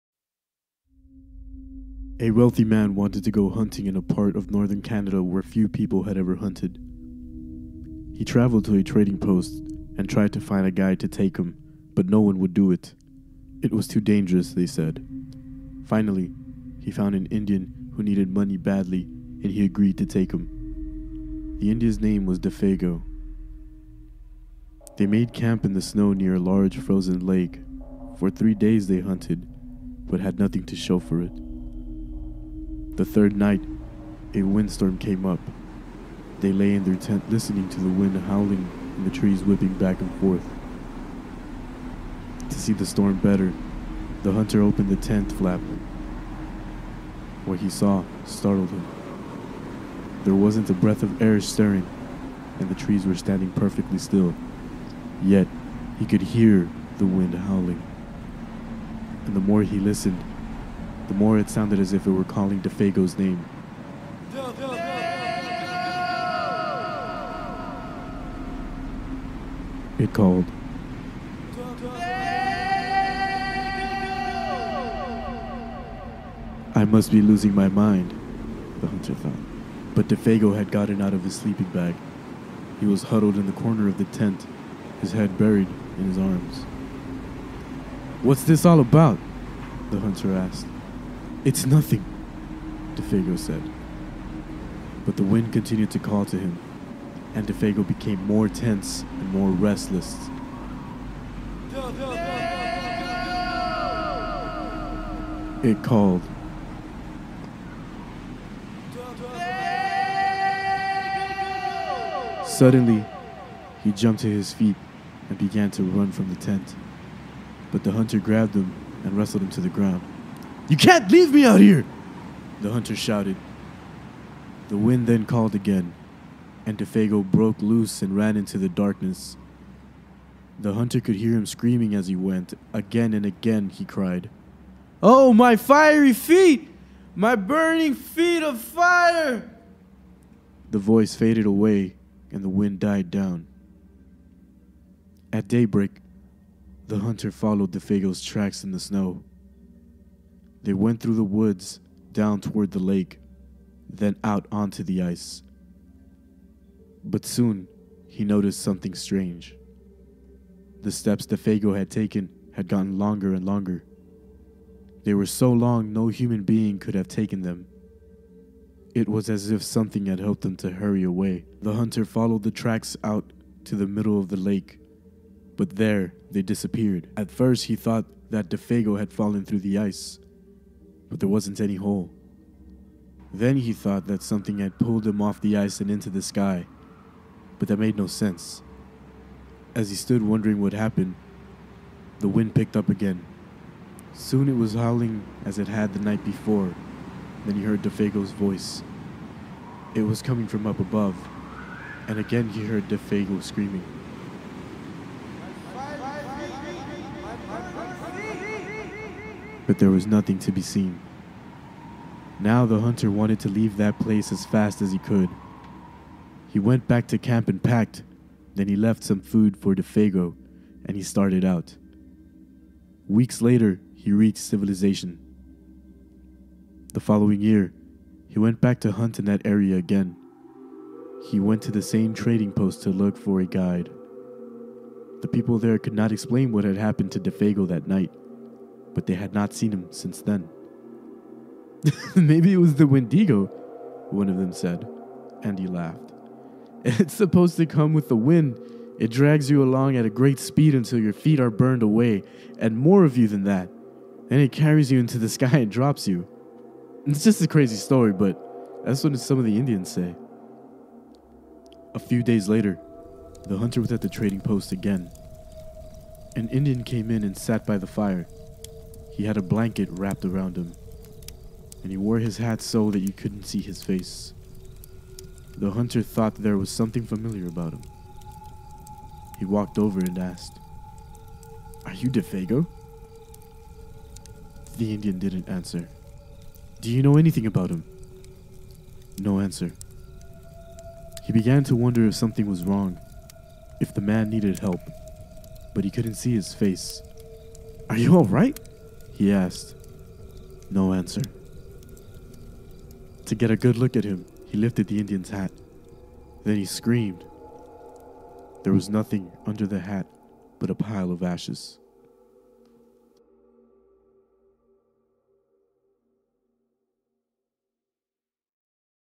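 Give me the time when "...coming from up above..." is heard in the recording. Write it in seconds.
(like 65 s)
200 s.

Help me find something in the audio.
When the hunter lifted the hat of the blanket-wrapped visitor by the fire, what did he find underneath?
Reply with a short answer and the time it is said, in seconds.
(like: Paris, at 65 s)
A pile of ashes, at 310 s.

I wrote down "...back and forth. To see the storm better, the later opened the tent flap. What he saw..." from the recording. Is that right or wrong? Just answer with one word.
wrong.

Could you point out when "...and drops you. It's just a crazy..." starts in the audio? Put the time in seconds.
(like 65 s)
255 s.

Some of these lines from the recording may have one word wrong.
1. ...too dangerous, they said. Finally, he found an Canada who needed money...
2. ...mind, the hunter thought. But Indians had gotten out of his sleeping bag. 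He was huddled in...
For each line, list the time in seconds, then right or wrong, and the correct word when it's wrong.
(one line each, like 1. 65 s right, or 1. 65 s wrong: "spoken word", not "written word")
1. 13 s wrong: "Indian", not "Canada"
2. 77 s wrong: "Defago", not "Indians".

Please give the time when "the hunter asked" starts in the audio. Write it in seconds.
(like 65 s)
89 s.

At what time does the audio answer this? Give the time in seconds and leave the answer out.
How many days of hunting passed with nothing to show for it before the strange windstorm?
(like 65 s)
28 s.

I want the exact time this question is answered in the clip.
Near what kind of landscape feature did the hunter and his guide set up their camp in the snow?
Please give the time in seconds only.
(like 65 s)
26 s.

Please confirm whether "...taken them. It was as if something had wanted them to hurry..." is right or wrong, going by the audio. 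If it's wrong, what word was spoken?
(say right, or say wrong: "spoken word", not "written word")
wrong: "helped", not "wanted".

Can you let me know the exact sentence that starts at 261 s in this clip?
A few days later, the hunter was at the trading post again.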